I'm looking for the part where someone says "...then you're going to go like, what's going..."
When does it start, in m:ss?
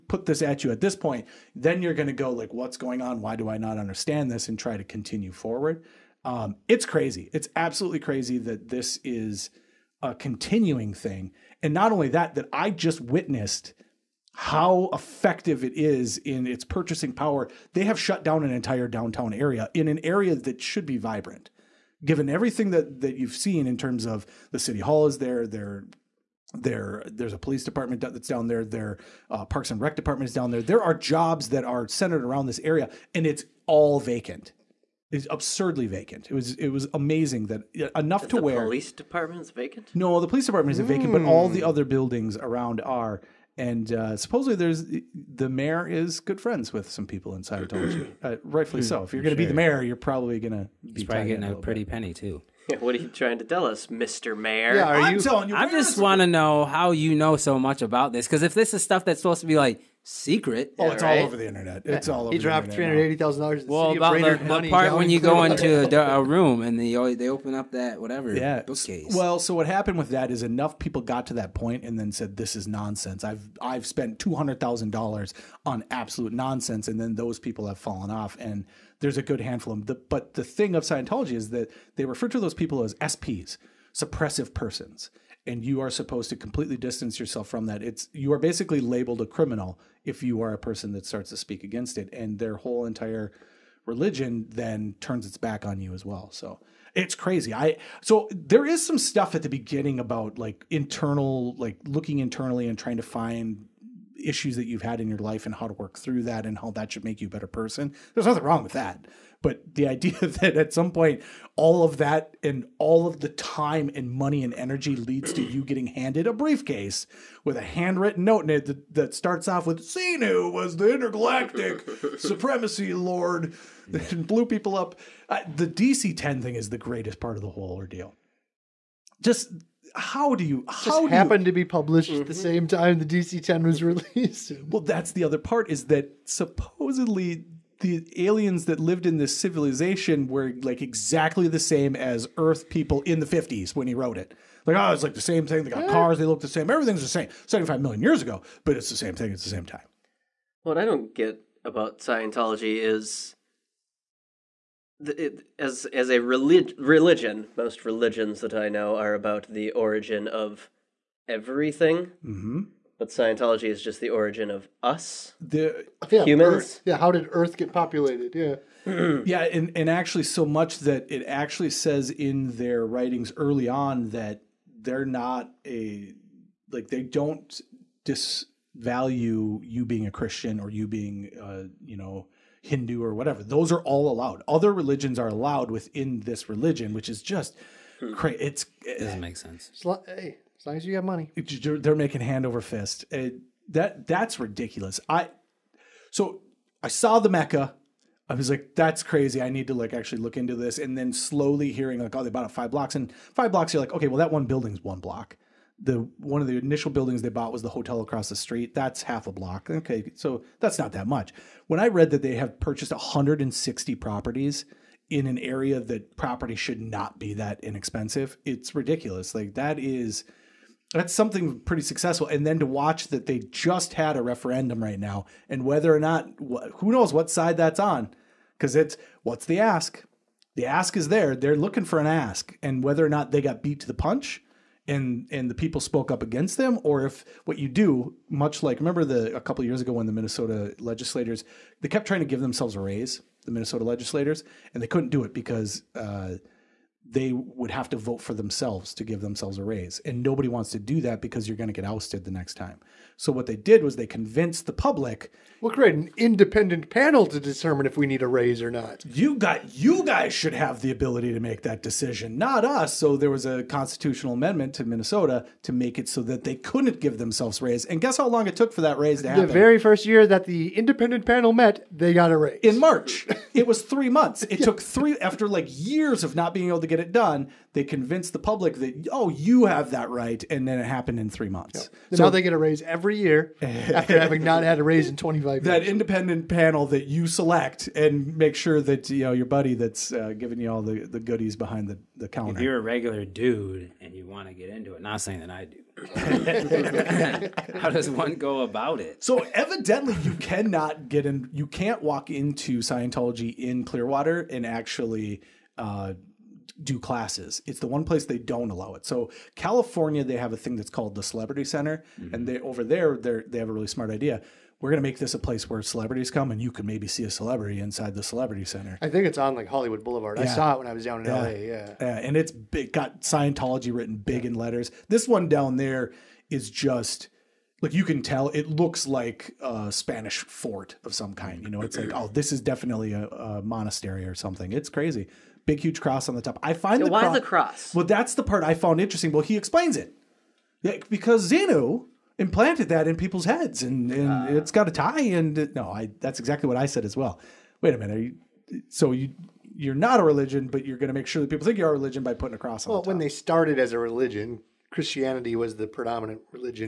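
0:01.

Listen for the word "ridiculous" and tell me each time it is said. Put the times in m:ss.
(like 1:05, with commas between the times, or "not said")
3:14, 3:38.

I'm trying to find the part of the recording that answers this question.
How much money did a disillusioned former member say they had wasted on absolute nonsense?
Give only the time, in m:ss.
1:14.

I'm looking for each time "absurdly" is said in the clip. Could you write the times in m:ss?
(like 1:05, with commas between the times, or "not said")
0:35.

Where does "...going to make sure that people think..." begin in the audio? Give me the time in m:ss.
5:50.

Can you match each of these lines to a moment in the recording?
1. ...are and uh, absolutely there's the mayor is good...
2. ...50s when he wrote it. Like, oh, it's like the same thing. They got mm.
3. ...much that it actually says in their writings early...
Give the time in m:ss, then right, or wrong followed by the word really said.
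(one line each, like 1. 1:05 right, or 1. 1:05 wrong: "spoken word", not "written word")
1. 0:42 wrong: "supposedly", not "absolutely"
2. 2:23 right
3. 2:50 right.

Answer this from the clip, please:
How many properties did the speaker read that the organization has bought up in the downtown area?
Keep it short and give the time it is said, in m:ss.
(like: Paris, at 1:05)
160, at 3:32.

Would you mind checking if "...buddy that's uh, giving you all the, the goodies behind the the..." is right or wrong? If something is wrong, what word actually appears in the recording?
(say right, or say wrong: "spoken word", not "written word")
right.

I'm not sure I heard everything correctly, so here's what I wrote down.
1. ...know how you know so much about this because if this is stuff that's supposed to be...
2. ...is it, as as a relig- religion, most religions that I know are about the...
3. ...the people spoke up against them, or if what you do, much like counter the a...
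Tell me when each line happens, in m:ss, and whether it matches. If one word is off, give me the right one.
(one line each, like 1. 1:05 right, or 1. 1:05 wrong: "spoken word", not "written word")
1. 0:56 right
2. 2:32 right
3. 3:55 wrong: "remember", not "counter".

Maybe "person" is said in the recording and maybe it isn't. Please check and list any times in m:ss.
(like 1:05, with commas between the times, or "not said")
1:24, 1:30, 1:47.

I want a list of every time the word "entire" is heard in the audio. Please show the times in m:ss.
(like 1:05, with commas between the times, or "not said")
0:18, 1:32.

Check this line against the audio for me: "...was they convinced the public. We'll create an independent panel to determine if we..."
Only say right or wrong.
right.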